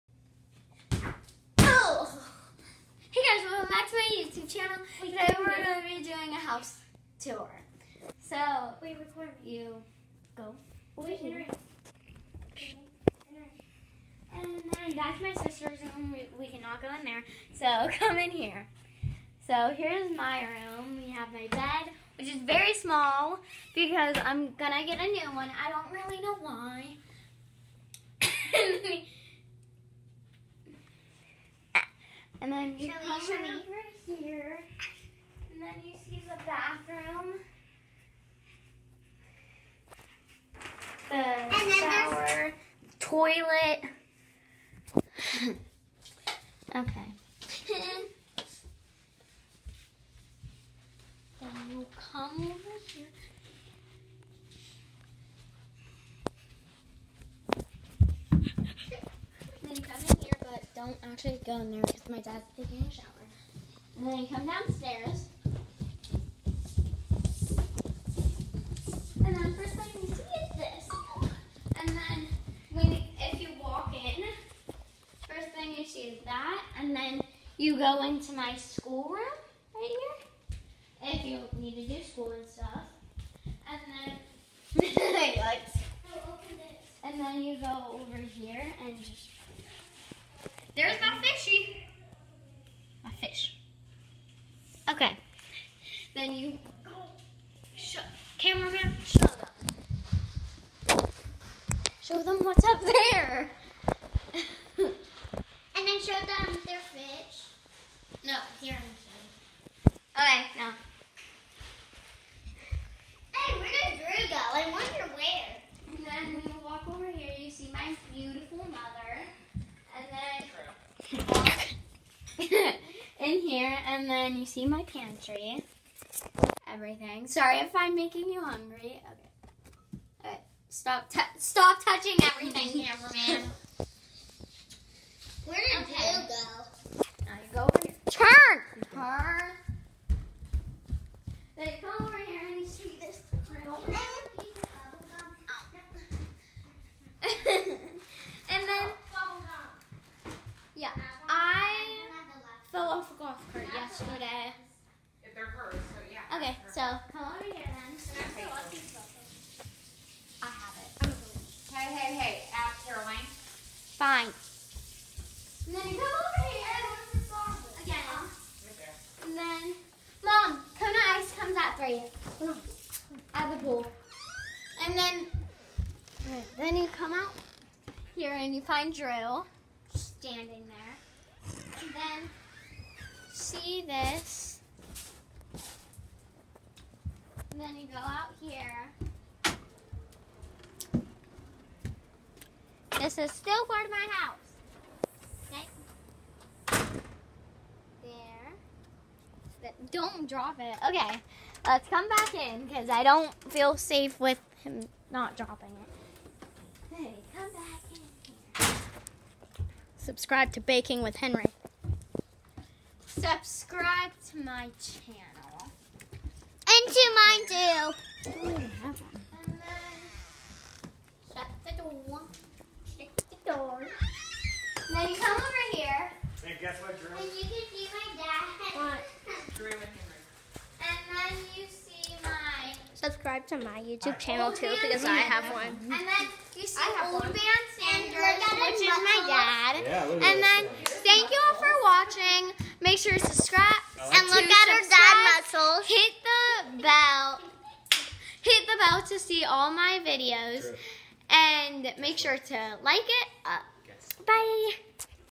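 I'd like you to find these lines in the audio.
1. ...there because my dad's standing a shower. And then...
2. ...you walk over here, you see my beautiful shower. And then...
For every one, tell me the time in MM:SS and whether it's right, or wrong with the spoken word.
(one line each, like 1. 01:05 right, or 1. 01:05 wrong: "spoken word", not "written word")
1. 01:01 wrong: "taking", not "standing"
2. 01:56 wrong: "mother", not "shower".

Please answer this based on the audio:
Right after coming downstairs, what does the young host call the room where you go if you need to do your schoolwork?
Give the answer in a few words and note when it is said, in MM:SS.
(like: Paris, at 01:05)
School room, at 01:18.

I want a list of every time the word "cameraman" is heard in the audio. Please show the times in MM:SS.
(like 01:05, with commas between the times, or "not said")
01:38, 02:12.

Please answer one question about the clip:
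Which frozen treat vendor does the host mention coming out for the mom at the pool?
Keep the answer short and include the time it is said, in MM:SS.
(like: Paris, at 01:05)
Kona Ice, at 02:50.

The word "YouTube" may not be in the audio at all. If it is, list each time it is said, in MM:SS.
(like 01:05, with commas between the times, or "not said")
00:04, 03:53.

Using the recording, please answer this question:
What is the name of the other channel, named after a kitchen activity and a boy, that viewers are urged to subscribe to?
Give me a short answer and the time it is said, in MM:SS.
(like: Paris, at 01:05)
Baking with Henry, at 03:30.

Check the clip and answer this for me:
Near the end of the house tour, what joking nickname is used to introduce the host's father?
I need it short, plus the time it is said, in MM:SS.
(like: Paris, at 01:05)
Old Man Sanders, at 03:57.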